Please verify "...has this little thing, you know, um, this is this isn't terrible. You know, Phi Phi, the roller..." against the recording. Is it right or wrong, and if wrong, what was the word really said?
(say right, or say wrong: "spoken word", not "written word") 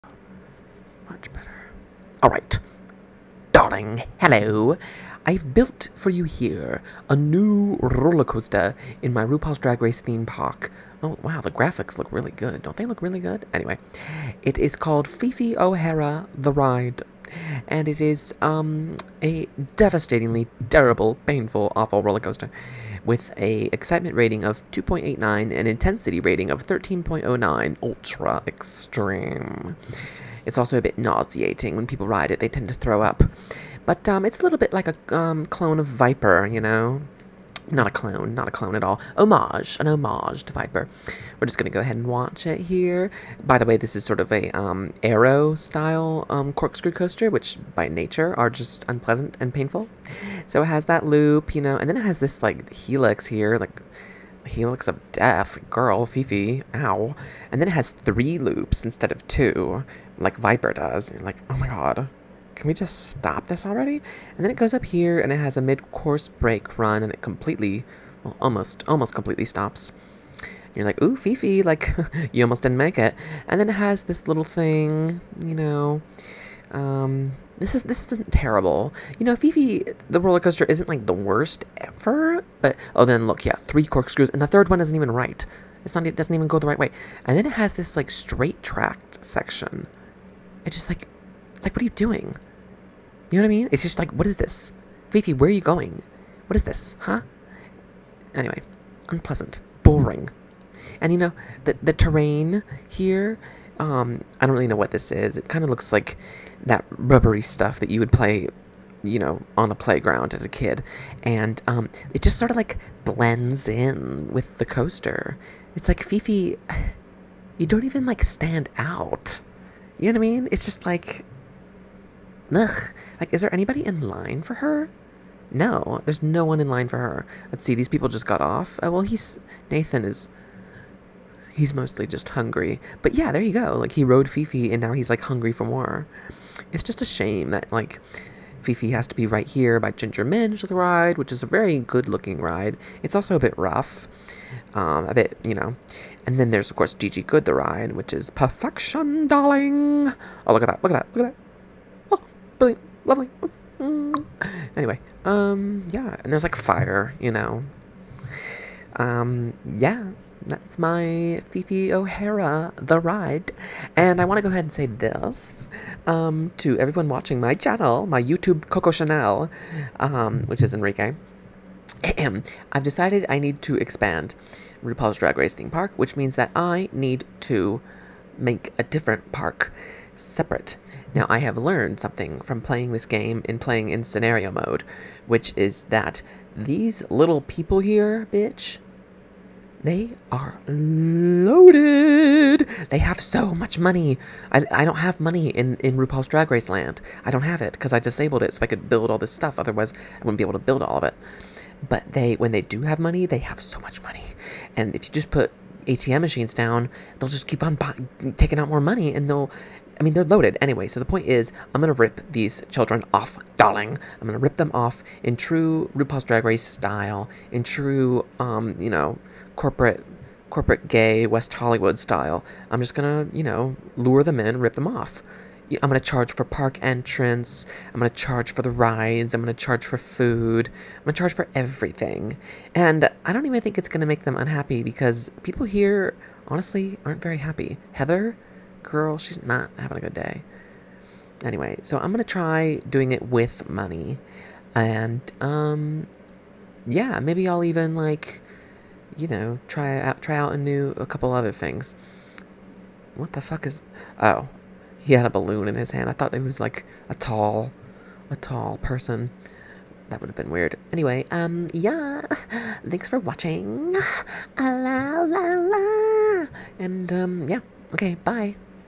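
right.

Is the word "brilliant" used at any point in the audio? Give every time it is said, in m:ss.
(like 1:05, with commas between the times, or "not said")
2:32.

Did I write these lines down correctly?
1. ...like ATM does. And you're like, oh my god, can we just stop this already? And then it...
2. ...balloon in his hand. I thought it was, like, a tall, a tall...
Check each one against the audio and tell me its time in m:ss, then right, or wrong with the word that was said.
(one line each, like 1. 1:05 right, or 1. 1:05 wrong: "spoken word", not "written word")
1. 1:00 wrong: "Viper", not "ATM"
2. 4:15 right.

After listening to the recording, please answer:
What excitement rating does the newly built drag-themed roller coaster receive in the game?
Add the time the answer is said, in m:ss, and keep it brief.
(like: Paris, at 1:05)
2.89, at 0:24.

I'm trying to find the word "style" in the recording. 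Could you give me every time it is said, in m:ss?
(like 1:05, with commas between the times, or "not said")
0:45, 3:36, 3:41.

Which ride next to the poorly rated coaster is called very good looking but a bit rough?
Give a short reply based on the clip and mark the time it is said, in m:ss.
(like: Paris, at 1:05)
Ginger Minj the ride, at 2:19.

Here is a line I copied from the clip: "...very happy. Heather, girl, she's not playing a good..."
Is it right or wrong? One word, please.
wrong.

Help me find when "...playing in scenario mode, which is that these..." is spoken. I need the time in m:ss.
3:03.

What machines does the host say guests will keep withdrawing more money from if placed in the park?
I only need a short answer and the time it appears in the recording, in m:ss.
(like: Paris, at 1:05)
ATM machines, at 3:25.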